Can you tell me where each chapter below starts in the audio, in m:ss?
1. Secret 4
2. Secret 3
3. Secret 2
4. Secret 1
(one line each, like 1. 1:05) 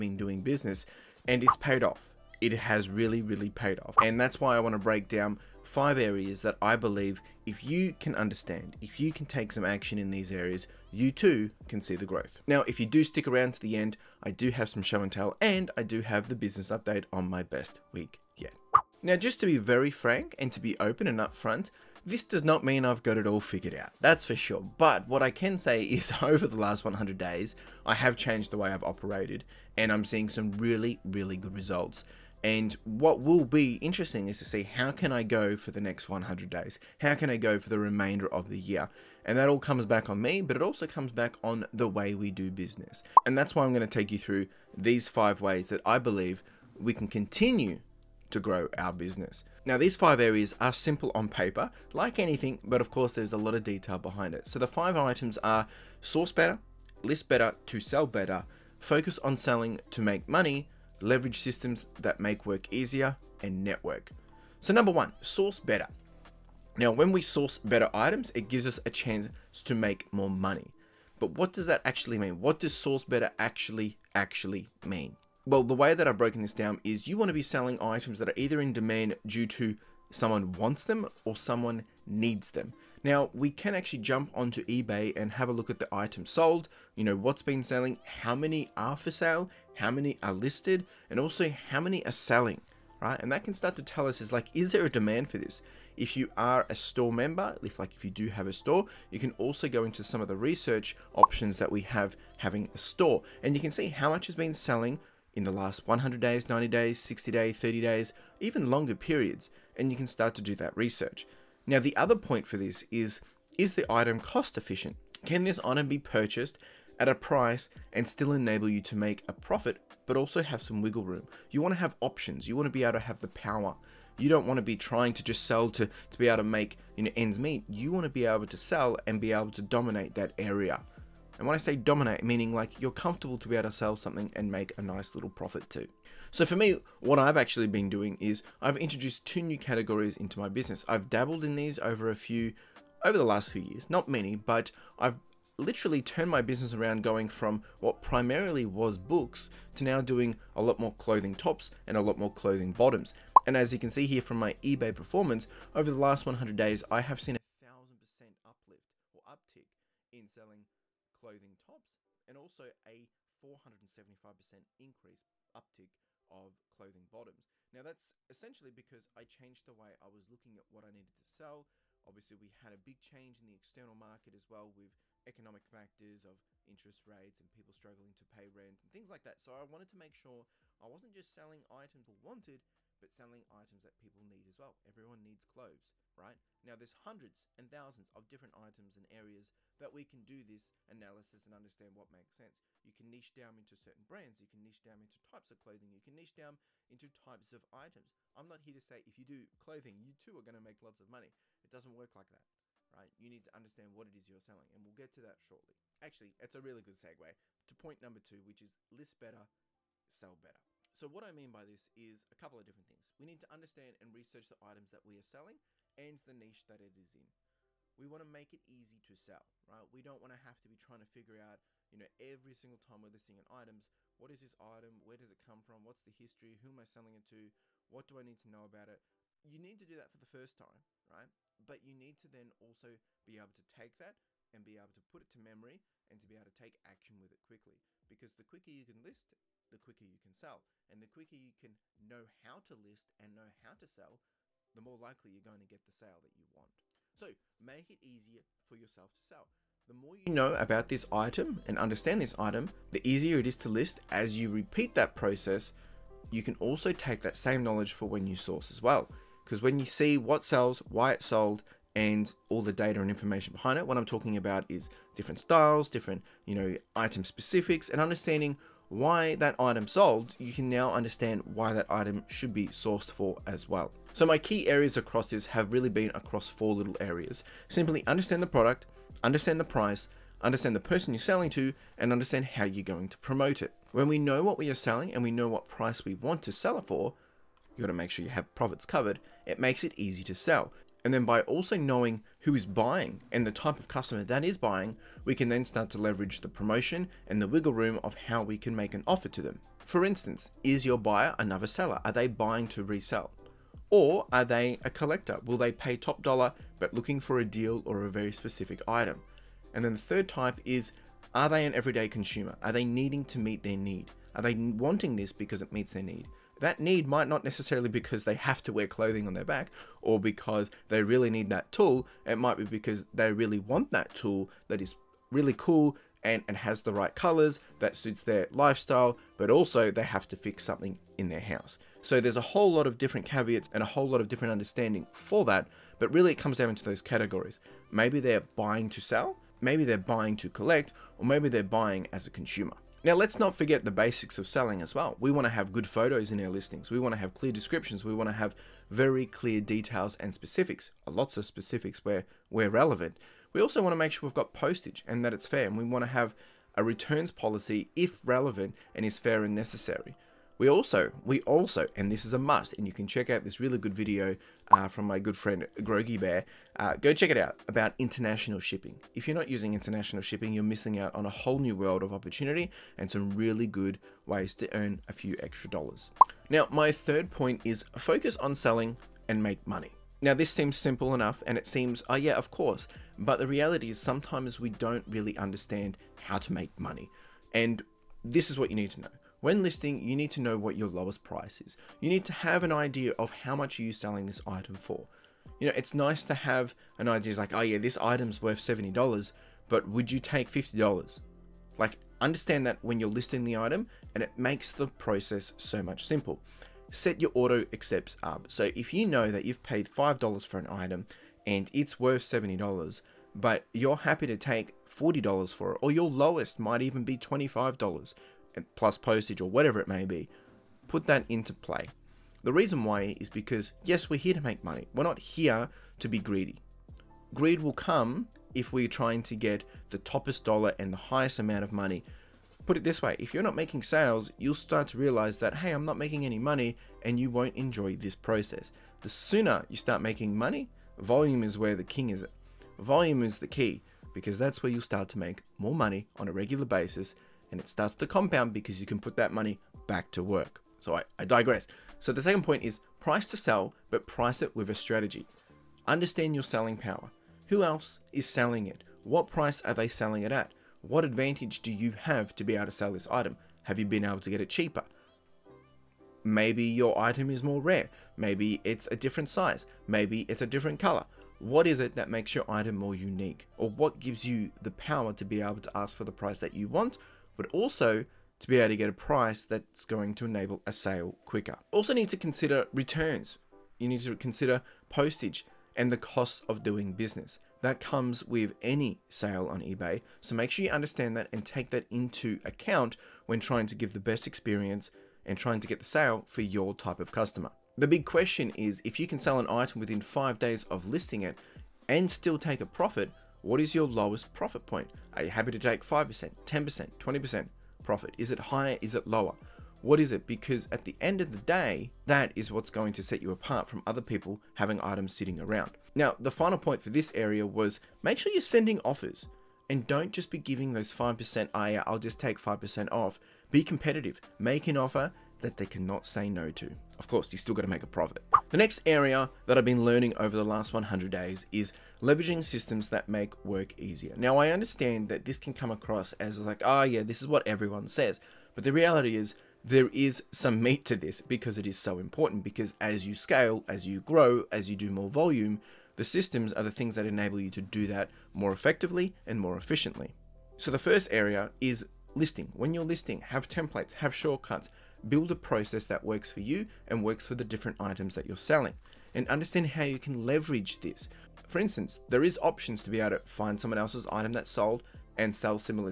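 1. 8:46
2. 6:15
3. 3:27
4. 1:04.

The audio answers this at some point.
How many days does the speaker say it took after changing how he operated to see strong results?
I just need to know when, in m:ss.
0:26.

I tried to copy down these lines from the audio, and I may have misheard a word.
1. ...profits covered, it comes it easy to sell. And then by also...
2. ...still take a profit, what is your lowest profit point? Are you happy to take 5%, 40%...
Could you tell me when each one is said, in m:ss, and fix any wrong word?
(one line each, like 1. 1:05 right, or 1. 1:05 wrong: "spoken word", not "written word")
1. 4:48 wrong: "makes", not "comes"
2. 8:22 wrong: "10", not "40".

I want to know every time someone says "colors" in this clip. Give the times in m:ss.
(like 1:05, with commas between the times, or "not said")
5:27, 7:50.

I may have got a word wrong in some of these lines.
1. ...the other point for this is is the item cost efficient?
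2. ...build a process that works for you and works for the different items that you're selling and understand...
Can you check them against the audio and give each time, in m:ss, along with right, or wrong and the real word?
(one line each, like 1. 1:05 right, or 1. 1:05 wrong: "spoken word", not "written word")
1. 1:51 right
2. 9:15 right.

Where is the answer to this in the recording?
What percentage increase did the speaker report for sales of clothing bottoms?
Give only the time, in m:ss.
2:43.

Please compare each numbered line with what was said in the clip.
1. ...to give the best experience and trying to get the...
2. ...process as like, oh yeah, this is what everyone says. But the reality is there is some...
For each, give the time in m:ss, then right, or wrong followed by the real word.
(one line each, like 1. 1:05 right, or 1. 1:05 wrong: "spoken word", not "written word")
1. 8:13 right
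2. 8:55 wrong: "across", not "process".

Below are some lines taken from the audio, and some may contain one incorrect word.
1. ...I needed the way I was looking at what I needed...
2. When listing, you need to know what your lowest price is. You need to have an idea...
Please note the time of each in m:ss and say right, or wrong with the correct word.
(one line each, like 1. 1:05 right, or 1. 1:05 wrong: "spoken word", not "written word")
1. 2:49 wrong: "changed", not "needed"
2. 6:29 right.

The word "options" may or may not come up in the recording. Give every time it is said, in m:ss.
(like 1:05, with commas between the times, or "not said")
1:41, 2:01, 9:22.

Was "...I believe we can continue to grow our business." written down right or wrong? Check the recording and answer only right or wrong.
right.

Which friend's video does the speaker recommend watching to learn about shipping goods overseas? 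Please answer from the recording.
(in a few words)
Grogi Bear.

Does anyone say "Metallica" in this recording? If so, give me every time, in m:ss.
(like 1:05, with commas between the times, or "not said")
not said.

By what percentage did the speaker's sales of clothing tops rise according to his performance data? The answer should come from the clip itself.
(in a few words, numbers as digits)
1000%.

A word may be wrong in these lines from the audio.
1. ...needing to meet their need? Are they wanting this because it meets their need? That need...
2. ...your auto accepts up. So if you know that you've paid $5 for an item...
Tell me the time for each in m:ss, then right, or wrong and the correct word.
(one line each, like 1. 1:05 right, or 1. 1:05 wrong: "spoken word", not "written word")
1. 5:12 right
2. 6:47 right.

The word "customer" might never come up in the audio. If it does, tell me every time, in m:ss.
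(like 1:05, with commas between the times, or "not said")
4:53, 8:17.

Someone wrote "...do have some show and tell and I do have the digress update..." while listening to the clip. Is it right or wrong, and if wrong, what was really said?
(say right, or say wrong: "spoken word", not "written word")
wrong: "business", not "digress".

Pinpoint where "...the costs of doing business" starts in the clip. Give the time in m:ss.
8:05.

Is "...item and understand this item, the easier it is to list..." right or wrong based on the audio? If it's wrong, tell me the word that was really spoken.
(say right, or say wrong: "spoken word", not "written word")
right.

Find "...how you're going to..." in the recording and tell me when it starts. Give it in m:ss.
4:42.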